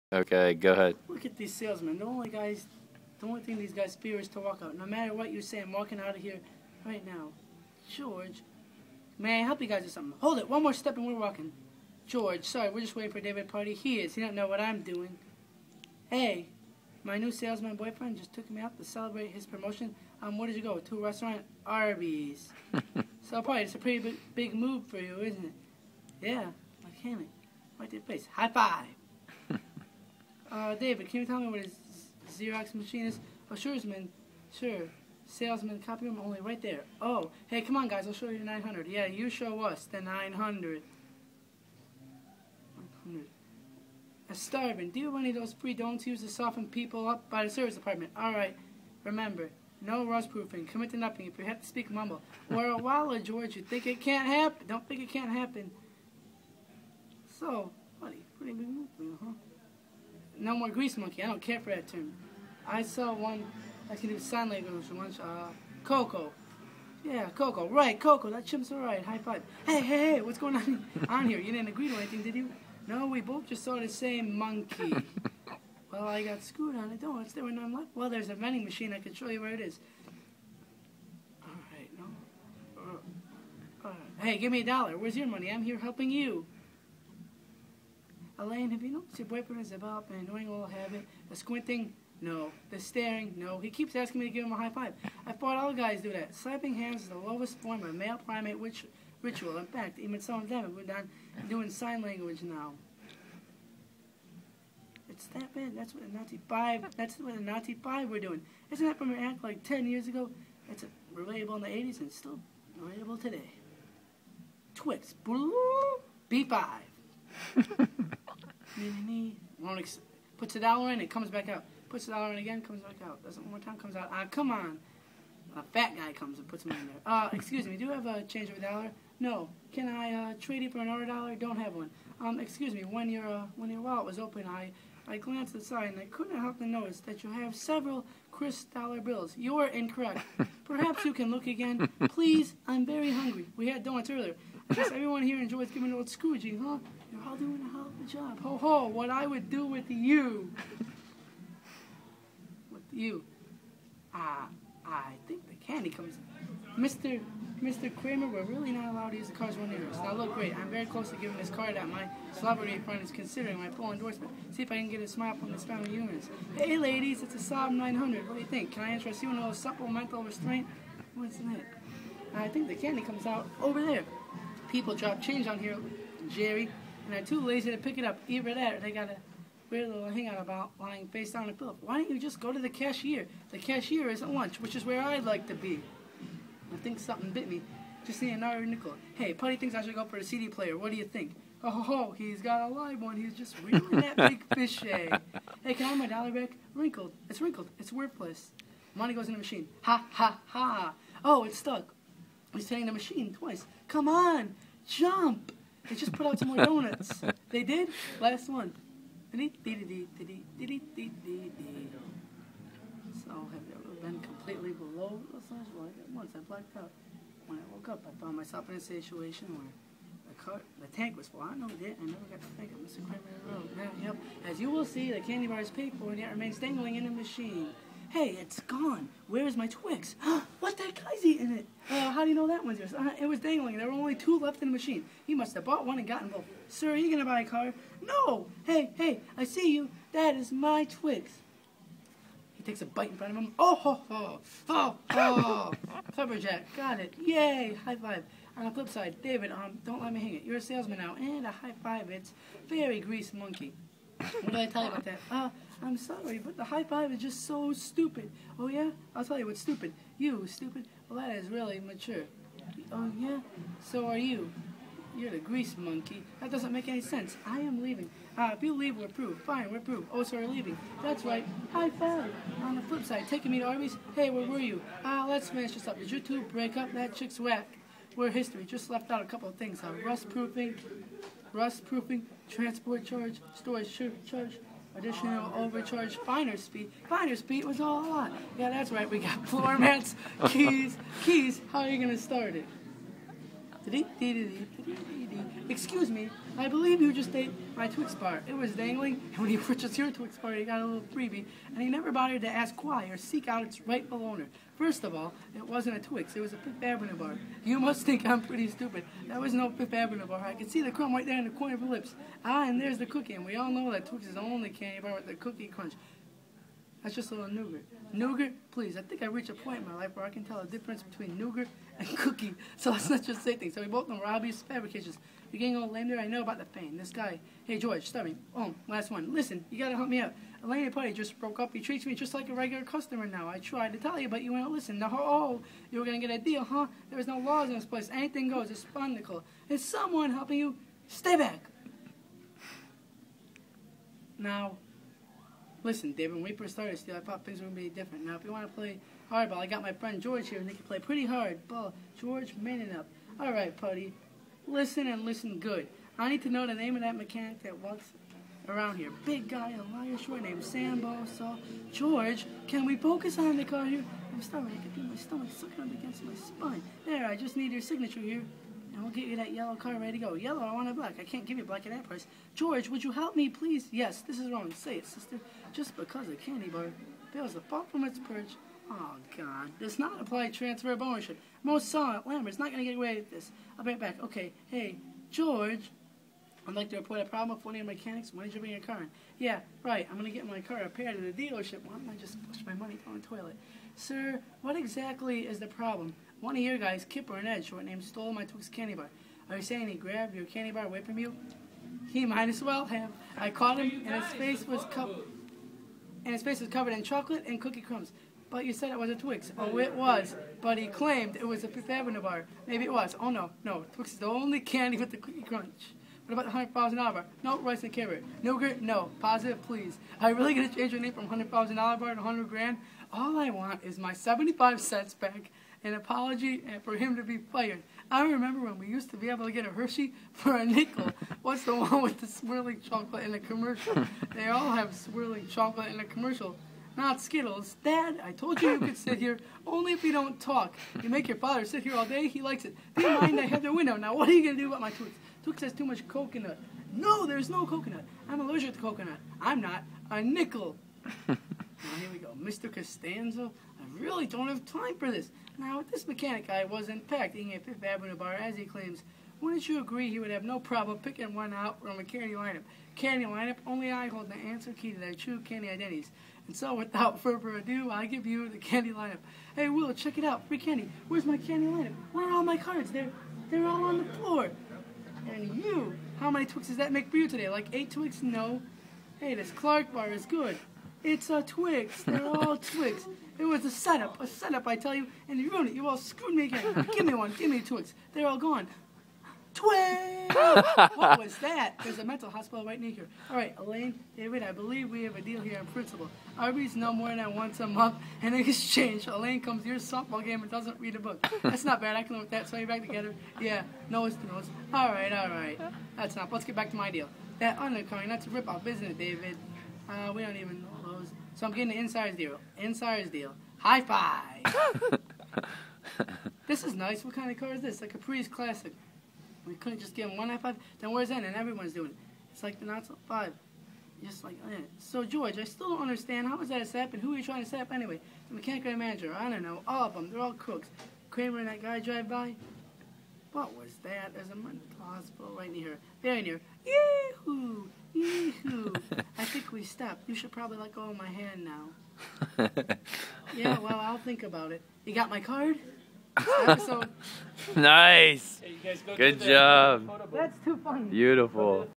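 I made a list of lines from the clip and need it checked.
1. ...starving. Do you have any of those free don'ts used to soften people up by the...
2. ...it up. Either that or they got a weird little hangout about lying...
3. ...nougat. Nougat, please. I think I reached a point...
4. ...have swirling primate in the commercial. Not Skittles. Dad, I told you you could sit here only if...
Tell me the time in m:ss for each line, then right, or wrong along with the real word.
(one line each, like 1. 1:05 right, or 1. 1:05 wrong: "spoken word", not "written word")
1. 0:44 right
2. 2:57 right
3. 5:17 right
4. 7:14 wrong: "chocolate", not "primate".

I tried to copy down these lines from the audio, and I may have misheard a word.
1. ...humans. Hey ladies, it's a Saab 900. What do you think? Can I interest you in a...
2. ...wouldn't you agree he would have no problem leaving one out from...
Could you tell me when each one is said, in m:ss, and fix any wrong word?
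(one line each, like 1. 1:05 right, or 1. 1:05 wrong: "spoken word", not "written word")
1. 2:45 right
2. 7:39 wrong: "picking", not "leaving".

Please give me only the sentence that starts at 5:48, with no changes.
Now, if you want to play hardball, I got my friend George here, and they can play pretty hard ball.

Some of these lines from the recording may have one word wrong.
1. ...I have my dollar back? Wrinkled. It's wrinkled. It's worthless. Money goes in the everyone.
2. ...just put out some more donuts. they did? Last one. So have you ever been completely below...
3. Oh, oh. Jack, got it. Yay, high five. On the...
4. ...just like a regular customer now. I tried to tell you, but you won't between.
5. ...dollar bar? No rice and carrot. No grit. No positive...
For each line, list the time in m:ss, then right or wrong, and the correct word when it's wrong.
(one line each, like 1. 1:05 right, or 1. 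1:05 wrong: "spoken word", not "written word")
1. 3:15 wrong: "machine", not "everyone"
2. 3:25 right
3. 4:04 right
4. 5:32 wrong: "listen", not "between"
5. 6:56 right.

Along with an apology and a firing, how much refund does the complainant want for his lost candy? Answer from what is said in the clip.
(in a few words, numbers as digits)
75 cents.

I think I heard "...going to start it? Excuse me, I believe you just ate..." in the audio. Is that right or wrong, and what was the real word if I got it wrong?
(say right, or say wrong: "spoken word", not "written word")
right.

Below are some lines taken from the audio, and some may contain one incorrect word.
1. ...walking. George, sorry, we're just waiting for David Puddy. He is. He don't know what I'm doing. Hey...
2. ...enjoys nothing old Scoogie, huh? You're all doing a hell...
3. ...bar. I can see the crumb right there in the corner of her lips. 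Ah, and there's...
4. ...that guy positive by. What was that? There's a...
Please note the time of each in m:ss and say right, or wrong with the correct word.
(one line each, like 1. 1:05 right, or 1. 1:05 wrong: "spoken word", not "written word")
1. 0:11 right
2. 2:25 wrong: "giving", not "nothing"
3. 5:10 right
4. 8:51 wrong: "drive", not "positive".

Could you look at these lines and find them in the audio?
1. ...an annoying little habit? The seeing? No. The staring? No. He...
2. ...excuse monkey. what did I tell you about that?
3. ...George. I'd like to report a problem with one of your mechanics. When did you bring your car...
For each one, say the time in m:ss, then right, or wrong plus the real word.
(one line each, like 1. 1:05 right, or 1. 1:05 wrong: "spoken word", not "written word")
1. 1:30 wrong: "squinting", not "seeing"
2. 4:12 wrong: "grease", not "excuse"
3. 6:25 right.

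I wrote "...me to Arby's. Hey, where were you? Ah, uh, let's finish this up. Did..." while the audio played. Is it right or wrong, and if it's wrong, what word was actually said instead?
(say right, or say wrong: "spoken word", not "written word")
right.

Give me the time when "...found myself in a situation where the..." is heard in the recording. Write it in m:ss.
3:38.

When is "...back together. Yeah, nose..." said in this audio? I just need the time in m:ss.
8:22.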